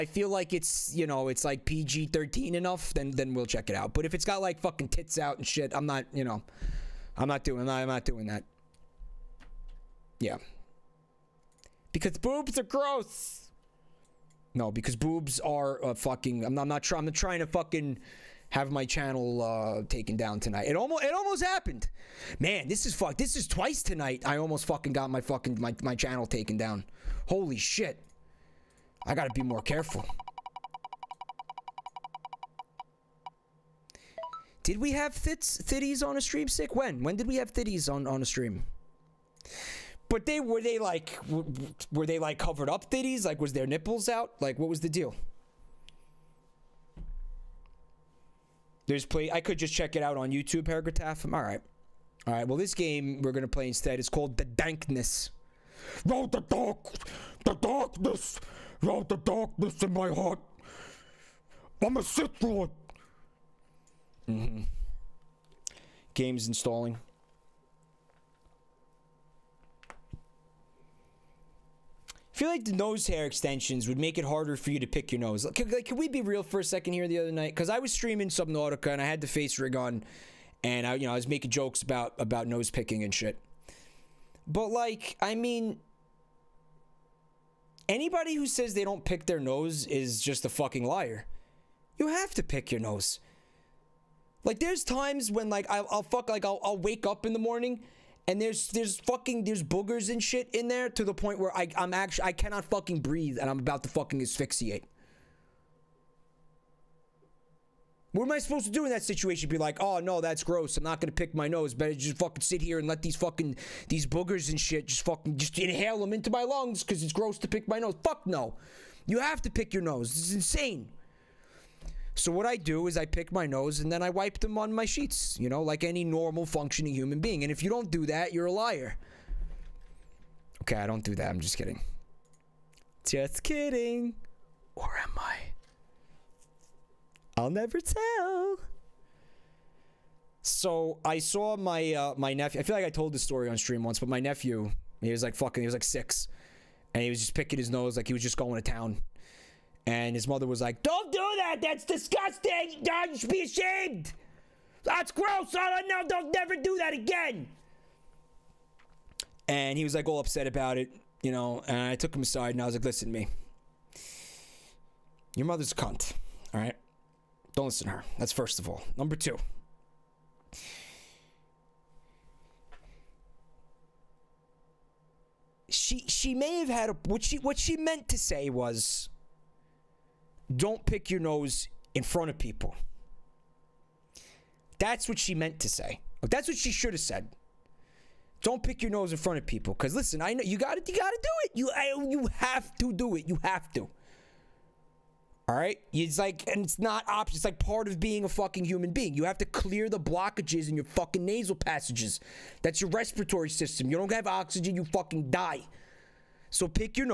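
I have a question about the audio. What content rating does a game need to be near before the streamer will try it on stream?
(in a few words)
PG 13.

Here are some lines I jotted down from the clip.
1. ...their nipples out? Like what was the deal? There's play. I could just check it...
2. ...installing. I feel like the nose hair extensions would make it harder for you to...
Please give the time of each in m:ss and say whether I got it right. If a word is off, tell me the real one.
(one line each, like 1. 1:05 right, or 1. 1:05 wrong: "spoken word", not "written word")
1. 0:43 right
2. 1:06 right.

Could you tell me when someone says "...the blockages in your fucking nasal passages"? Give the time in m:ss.
3:19.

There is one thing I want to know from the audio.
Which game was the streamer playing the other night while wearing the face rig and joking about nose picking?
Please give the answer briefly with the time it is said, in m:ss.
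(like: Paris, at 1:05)
Subnautica, at 1:18.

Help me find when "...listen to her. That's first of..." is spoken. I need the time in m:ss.
2:47.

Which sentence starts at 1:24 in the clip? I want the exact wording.
But like, I mean, Anybody who says they don't pick their nose is just a fucking liar.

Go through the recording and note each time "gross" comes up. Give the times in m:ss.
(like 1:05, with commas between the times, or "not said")
0:12, 1:50, 1:57, 2:35.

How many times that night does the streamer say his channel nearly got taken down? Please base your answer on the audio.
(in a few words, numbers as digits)
Twice.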